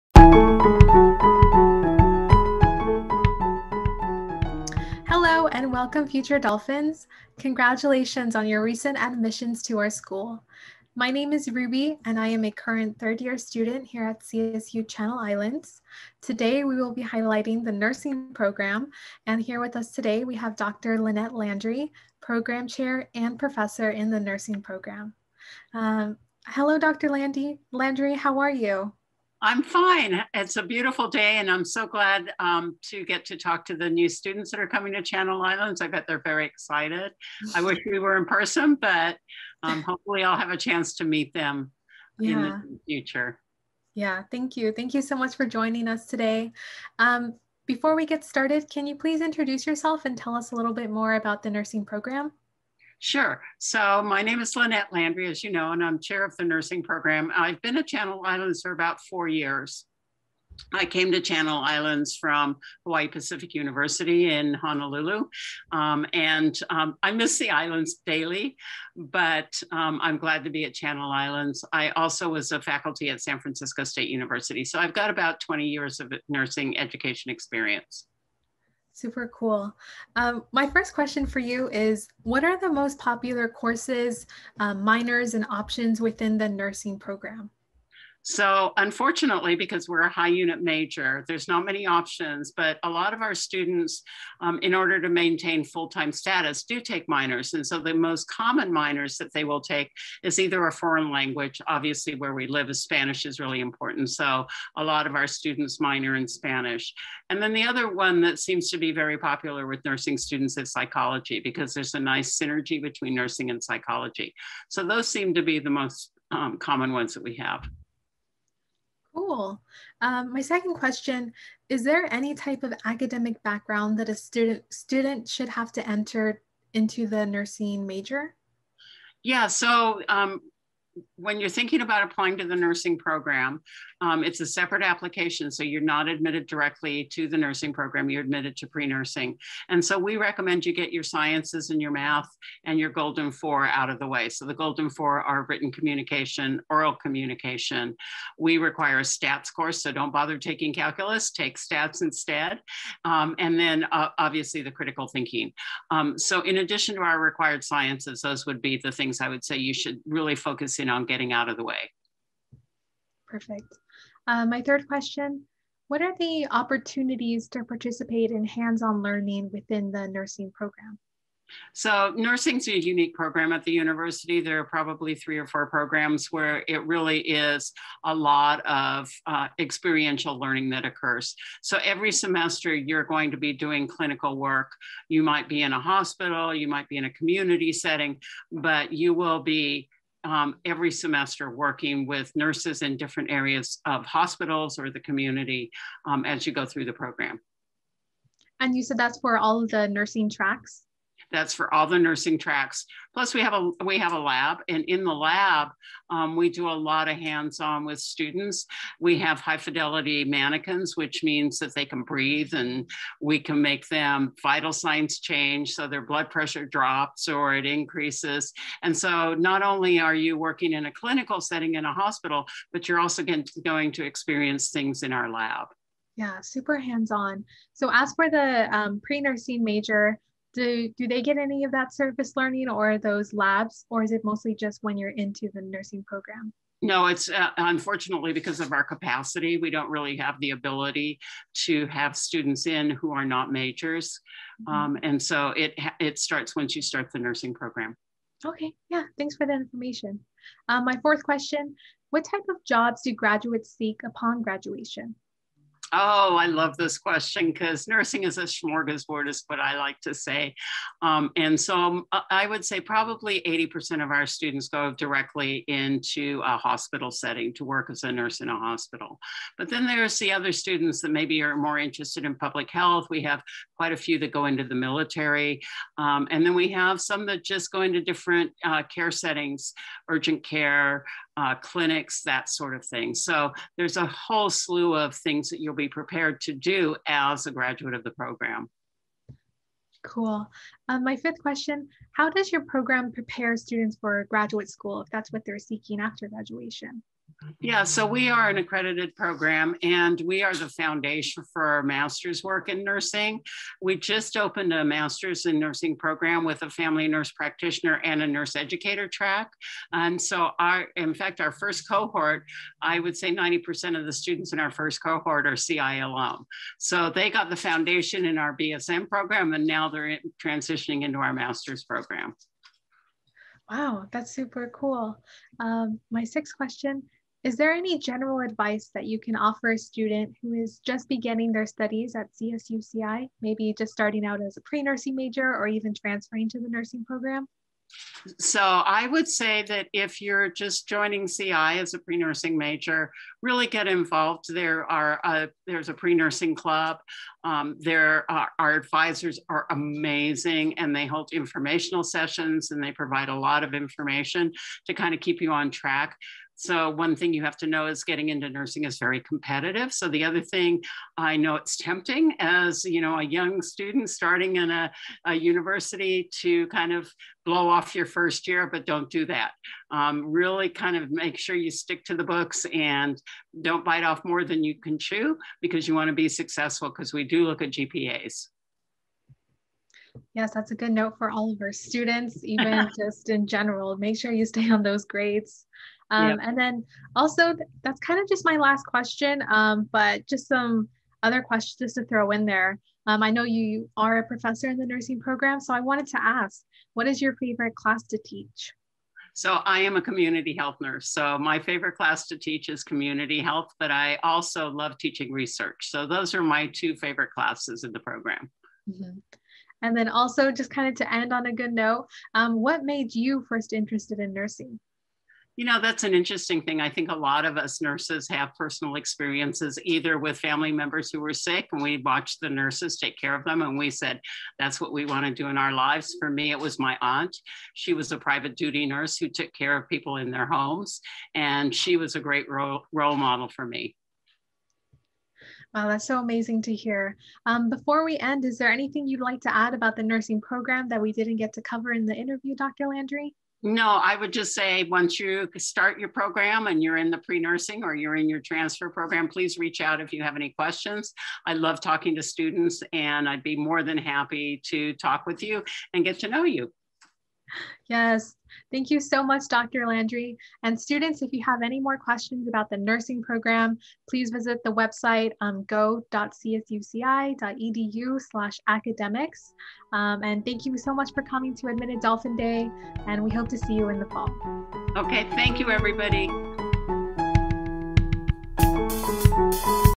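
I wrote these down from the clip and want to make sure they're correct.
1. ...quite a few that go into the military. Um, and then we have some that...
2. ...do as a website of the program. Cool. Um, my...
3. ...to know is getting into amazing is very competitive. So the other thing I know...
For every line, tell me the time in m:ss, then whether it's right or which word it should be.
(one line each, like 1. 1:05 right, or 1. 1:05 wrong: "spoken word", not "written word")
1. 4:33 right
2. 4:46 wrong: "graduate", not "website"
3. 5:57 wrong: "nursing", not "amazing".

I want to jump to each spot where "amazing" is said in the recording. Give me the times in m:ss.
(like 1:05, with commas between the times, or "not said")
5:49, 7:16.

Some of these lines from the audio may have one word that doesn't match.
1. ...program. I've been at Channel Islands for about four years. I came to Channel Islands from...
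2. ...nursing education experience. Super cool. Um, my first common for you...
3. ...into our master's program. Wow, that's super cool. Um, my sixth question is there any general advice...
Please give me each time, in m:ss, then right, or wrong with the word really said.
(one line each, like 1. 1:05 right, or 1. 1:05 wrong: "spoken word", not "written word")
1. 0:56 right
2. 1:16 wrong: "question", not "common"
3. 5:21 right.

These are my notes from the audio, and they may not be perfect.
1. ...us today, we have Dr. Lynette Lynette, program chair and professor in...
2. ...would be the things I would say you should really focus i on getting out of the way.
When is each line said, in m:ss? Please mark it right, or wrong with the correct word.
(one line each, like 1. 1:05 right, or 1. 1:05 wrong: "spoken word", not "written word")
1. 0:19 wrong: "Landry", not "Lynette"
2. 2:38 right.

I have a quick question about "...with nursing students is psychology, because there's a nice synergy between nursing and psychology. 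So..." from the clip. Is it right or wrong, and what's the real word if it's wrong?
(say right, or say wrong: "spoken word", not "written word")
right.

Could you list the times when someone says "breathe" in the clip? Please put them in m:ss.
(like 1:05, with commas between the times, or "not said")
3:32.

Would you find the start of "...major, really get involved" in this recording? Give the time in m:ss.
5:42.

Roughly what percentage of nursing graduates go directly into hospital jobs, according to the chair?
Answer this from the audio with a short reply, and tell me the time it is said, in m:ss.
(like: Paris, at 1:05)
80%, at 4:23.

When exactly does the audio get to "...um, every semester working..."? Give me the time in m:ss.
3:10.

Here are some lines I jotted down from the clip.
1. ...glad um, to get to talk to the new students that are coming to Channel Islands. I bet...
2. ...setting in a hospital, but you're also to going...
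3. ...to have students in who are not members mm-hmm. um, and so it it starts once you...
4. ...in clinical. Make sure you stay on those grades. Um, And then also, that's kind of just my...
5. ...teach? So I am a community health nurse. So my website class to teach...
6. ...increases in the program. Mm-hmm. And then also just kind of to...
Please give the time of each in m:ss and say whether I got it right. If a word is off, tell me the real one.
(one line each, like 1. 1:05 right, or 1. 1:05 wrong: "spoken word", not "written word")
1. 0:31 right
2. 3:41 right
3. 4:01 wrong: "majors", not "members"
4. 6:23 wrong: "general", not "clinical"
5. 6:38 wrong: "favorite", not "website"
6. 6:47 wrong: "classes", not "increases".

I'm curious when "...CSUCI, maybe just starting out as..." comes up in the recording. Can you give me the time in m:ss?
5:32.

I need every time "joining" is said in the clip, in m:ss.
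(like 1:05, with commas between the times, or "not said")
0:45, 5:40.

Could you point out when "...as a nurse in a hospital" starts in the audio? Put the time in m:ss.
4:27.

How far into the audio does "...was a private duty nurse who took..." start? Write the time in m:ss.
7:07.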